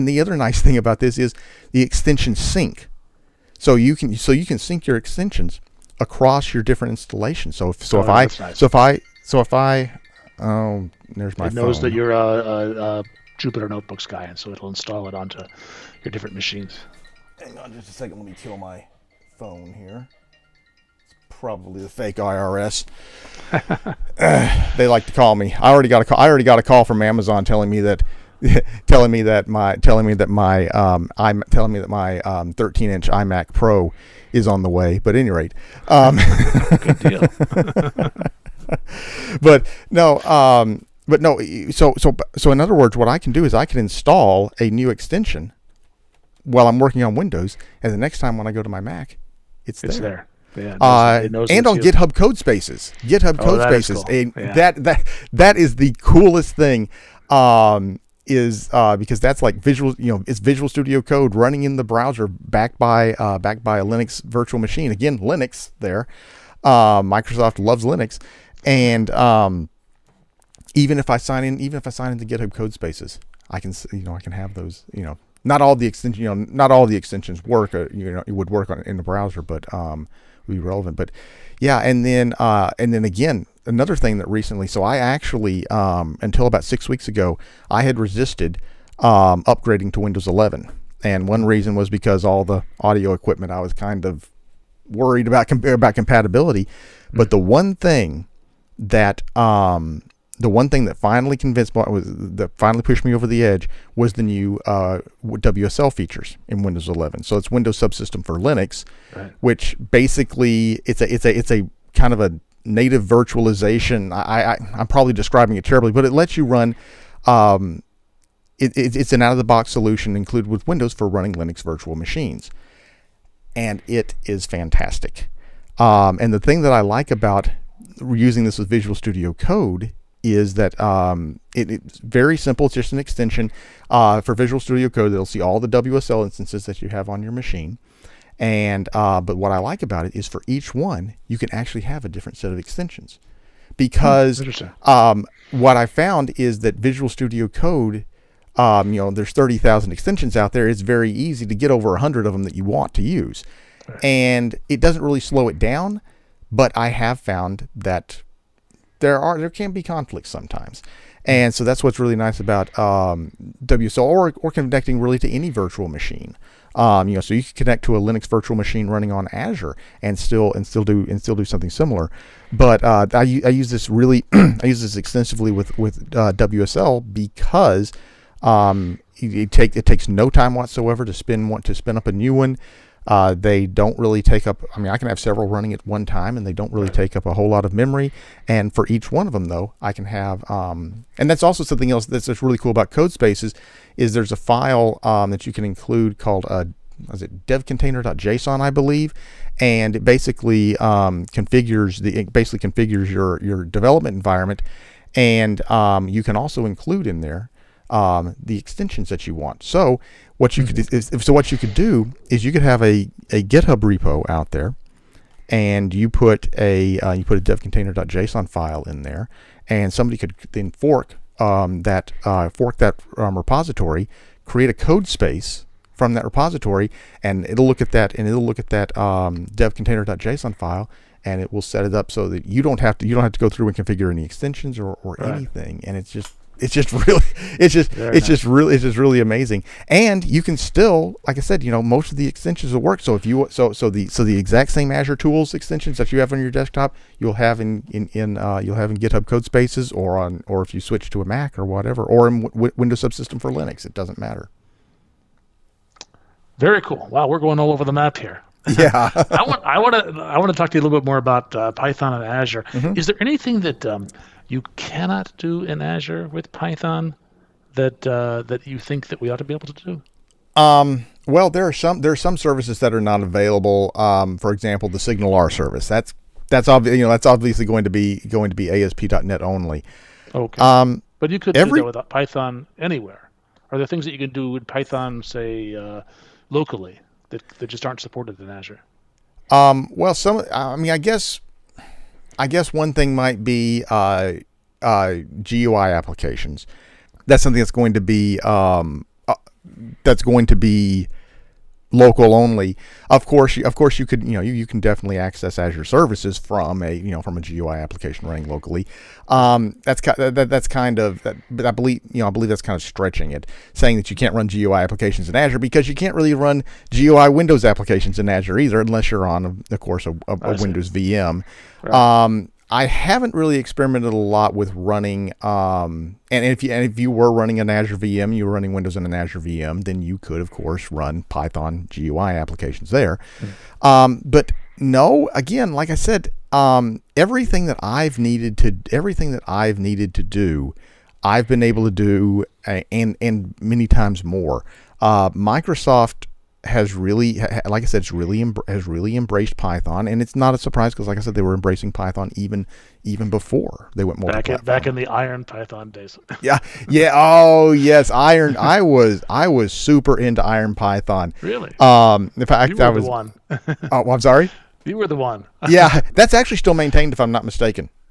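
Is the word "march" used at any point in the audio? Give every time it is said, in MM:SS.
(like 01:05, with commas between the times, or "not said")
not said.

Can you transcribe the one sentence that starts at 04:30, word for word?
Um, well, there are some there are some services that are not available.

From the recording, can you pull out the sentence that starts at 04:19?
I want I want to I want to talk to you a little bit more about uh, Python and Azure.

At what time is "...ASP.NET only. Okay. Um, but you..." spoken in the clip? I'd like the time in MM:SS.
04:38.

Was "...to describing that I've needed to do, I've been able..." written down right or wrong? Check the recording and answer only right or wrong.
wrong.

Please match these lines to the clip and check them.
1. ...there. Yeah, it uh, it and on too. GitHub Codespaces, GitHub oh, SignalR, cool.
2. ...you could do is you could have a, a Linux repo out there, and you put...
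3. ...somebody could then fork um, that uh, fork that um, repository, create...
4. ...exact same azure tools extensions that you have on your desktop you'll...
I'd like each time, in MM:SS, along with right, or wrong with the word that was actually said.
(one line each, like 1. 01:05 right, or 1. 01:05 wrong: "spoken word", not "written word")
1. 00:49 wrong: "Codespaces", not "SignalR"
2. 03:31 wrong: "GitHub", not "Linux"
3. 03:39 right
4. 04:04 right.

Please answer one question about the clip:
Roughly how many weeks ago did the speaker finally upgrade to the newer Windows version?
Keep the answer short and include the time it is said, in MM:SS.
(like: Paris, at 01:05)
6, at 01:26.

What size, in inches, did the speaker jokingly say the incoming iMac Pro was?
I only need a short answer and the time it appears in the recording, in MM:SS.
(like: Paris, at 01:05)
13, at 00:32.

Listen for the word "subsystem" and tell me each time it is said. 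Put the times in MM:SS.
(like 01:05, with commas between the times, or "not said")
01:47, 04:13.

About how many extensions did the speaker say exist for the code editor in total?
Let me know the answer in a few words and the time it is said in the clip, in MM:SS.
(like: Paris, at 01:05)
30,000, at 02:29.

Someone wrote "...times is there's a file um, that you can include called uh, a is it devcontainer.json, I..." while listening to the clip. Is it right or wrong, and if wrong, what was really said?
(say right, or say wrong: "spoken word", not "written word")
wrong: "codespaces", not "times".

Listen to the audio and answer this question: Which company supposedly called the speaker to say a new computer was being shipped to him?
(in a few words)
Amazon.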